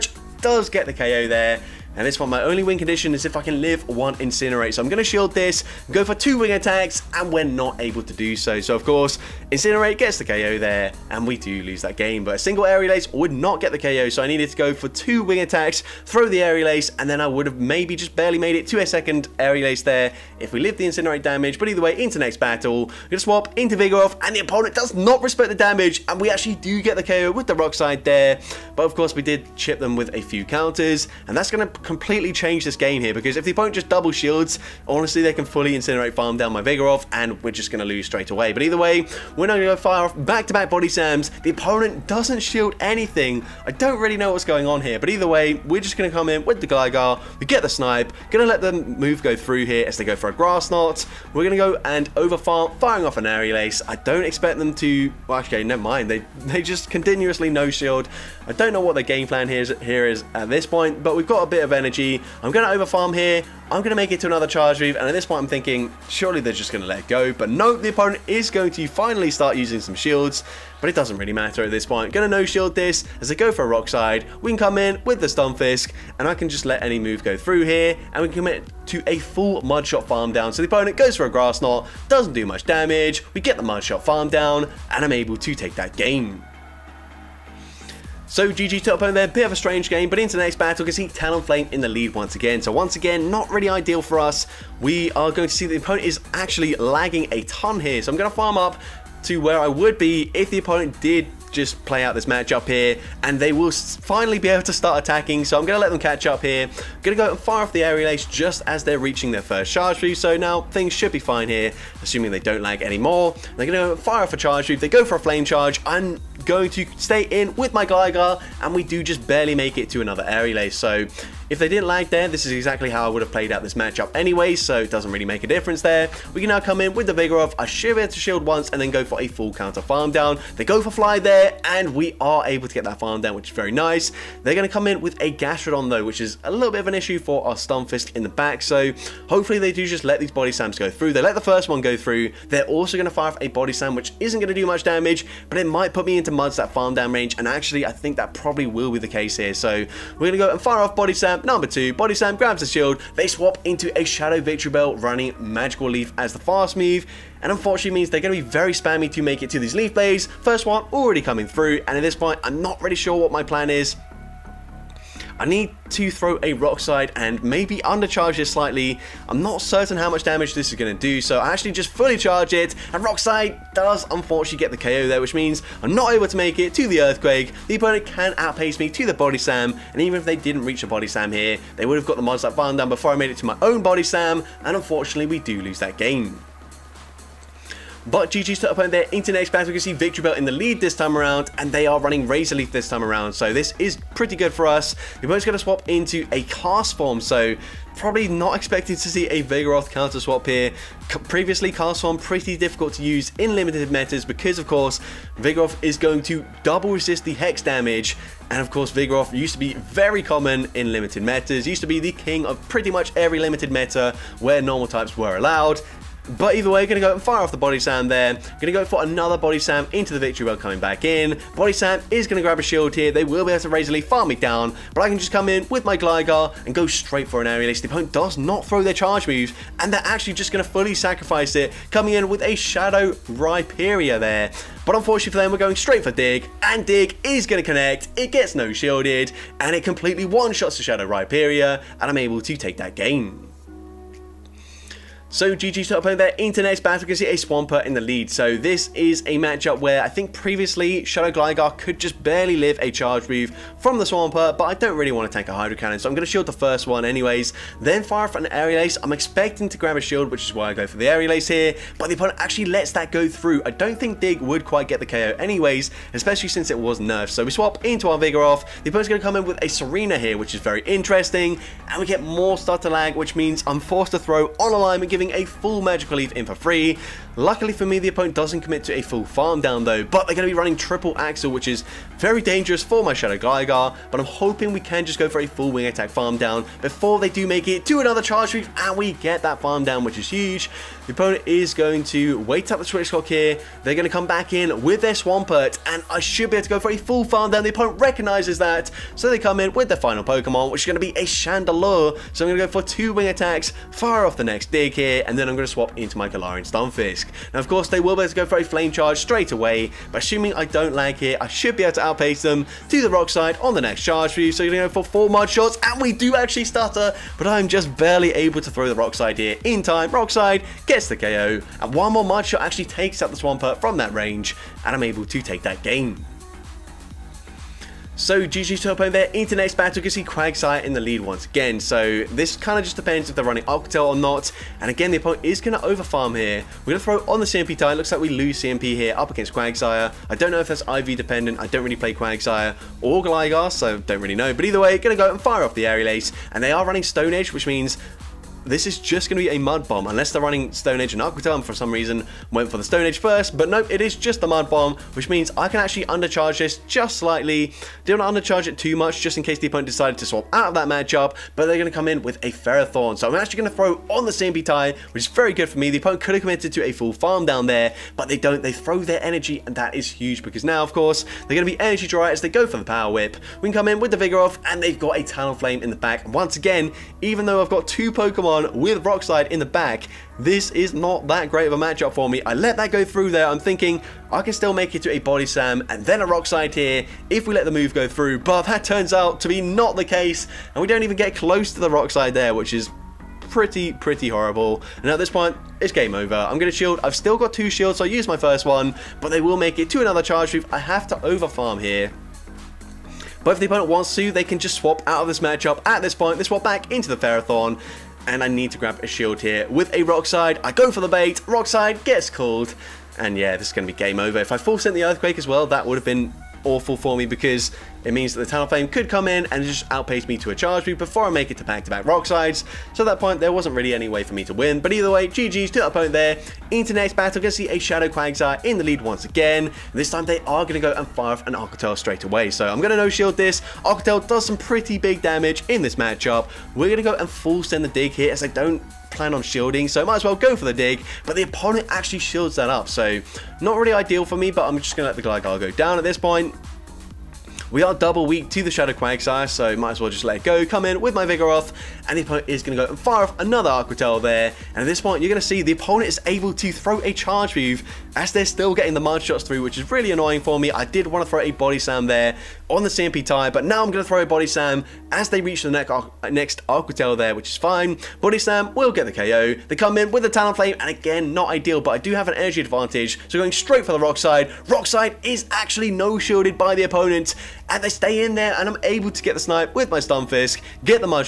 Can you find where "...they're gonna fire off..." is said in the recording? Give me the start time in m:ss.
1:53.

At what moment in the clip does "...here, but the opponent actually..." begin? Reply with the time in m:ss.
4:21.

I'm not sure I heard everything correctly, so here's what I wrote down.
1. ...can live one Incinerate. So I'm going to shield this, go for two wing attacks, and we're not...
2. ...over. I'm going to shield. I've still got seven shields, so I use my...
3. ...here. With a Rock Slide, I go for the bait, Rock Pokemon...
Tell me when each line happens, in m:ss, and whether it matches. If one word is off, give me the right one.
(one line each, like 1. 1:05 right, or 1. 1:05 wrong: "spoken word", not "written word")
1. 0:03 right
2. 6:36 wrong: "two", not "seven"
3. 6:49 wrong: "Slide", not "Pokemon".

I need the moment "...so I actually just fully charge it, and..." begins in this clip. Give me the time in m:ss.
2:51.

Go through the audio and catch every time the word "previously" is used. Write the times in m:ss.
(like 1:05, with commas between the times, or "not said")
3:21, 4:10.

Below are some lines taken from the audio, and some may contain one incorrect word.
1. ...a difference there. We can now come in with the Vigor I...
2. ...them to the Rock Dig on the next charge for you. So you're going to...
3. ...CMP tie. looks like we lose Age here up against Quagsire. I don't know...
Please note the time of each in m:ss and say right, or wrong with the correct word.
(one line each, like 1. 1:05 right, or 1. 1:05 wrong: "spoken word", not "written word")
1. 2:05 right
2. 5:12 wrong: "Slide", not "Dig"
3. 5:37 wrong: "CMP", not "Age".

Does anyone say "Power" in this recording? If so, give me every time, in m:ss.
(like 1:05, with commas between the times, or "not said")
6:12.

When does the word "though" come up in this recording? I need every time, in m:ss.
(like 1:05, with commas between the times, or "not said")
2:15, 4:39, 6:17.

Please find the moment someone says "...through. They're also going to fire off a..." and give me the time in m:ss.
2:21.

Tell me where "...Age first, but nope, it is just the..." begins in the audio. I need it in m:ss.
5:53.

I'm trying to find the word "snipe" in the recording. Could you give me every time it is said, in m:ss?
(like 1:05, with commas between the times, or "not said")
0:47, 7:59.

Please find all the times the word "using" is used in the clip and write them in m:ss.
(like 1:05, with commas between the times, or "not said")
1:09.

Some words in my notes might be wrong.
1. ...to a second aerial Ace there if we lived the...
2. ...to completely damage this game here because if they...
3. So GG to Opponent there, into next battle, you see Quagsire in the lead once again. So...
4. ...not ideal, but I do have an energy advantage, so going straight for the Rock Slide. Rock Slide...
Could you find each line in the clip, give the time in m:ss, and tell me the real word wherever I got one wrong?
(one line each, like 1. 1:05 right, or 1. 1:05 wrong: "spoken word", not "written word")
1. 0:18 right
2. 0:31 wrong: "change", not "damage"
3. 5:28 right
4. 7:51 right.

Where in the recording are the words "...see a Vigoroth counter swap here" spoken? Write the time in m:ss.
3:19.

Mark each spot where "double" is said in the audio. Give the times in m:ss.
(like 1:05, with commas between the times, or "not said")
0:33, 3:26, 7:27.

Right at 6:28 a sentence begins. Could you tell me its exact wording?
But that turns out to be not the case.